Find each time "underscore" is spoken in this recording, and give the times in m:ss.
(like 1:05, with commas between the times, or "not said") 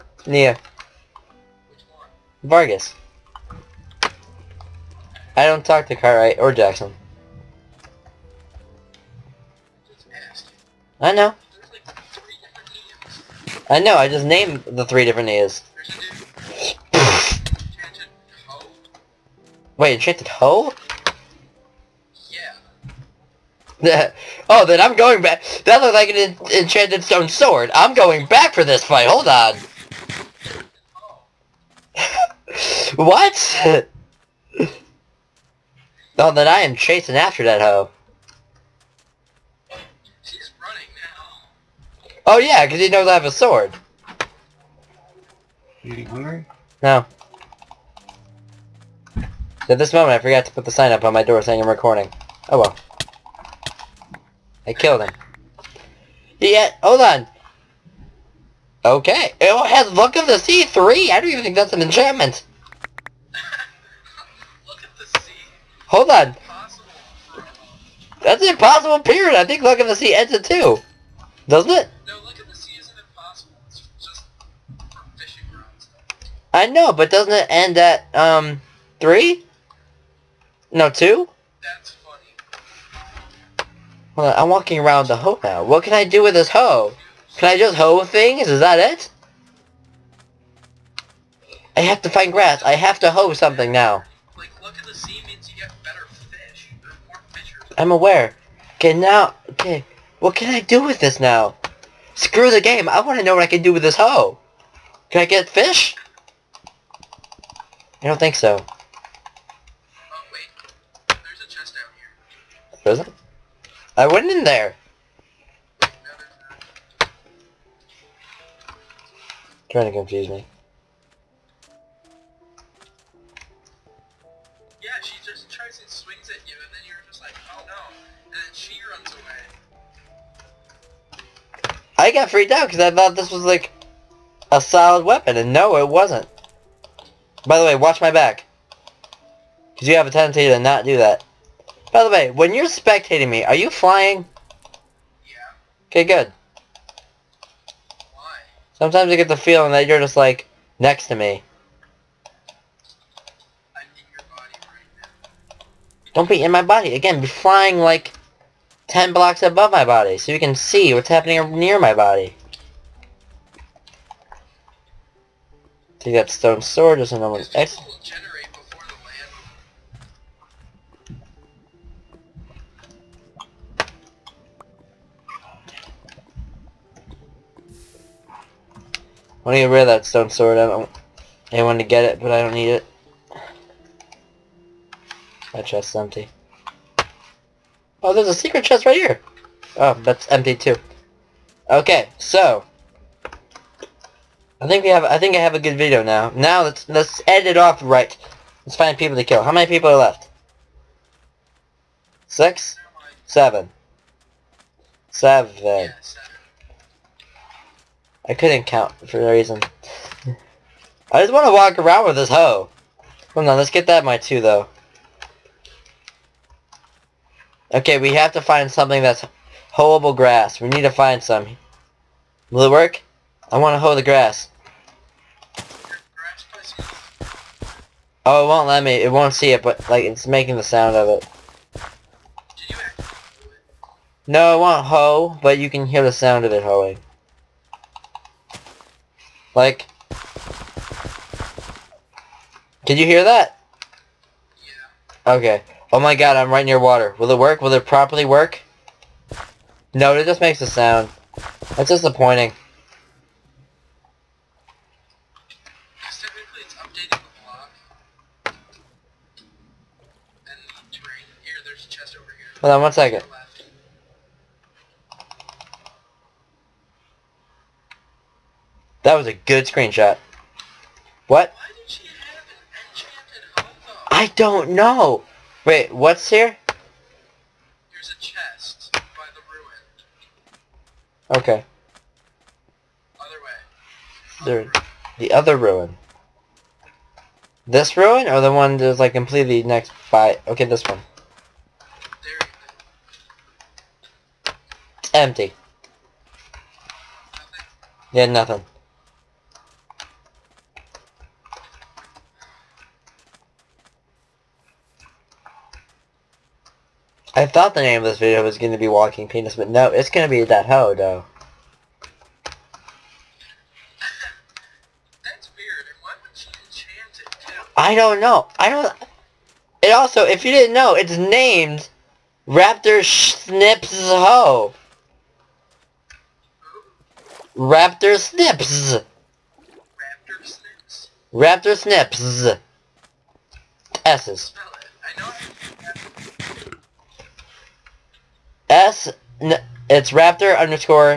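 5:40.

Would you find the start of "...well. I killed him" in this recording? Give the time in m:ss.
0:52.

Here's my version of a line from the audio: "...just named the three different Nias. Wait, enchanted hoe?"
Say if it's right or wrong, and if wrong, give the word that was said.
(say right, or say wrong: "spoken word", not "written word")
right.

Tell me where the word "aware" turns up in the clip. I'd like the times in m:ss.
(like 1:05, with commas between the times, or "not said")
1:37.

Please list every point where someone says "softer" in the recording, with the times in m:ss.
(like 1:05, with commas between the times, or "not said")
not said.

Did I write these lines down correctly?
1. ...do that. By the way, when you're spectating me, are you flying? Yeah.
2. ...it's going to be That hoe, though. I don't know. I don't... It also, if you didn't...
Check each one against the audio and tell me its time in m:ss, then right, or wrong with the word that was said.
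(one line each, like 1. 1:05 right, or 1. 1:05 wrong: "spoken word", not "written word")
1. 2:20 right
2. 5:09 right.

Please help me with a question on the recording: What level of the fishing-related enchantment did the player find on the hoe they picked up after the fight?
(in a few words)
3.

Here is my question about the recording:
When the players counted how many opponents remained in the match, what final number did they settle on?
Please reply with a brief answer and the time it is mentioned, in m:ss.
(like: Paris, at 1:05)
7, at 3:25.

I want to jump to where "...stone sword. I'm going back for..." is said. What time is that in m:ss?
0:27.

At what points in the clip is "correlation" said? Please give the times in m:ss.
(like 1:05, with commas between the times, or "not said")
not said.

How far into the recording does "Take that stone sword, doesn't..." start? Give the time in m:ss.
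2:45.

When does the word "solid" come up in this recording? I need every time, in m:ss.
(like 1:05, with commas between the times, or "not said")
2:14.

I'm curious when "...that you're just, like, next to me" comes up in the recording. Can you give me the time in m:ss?
2:29.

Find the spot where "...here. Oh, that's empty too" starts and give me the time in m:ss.
3:08.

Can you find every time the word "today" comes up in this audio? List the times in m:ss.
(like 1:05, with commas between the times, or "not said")
not said.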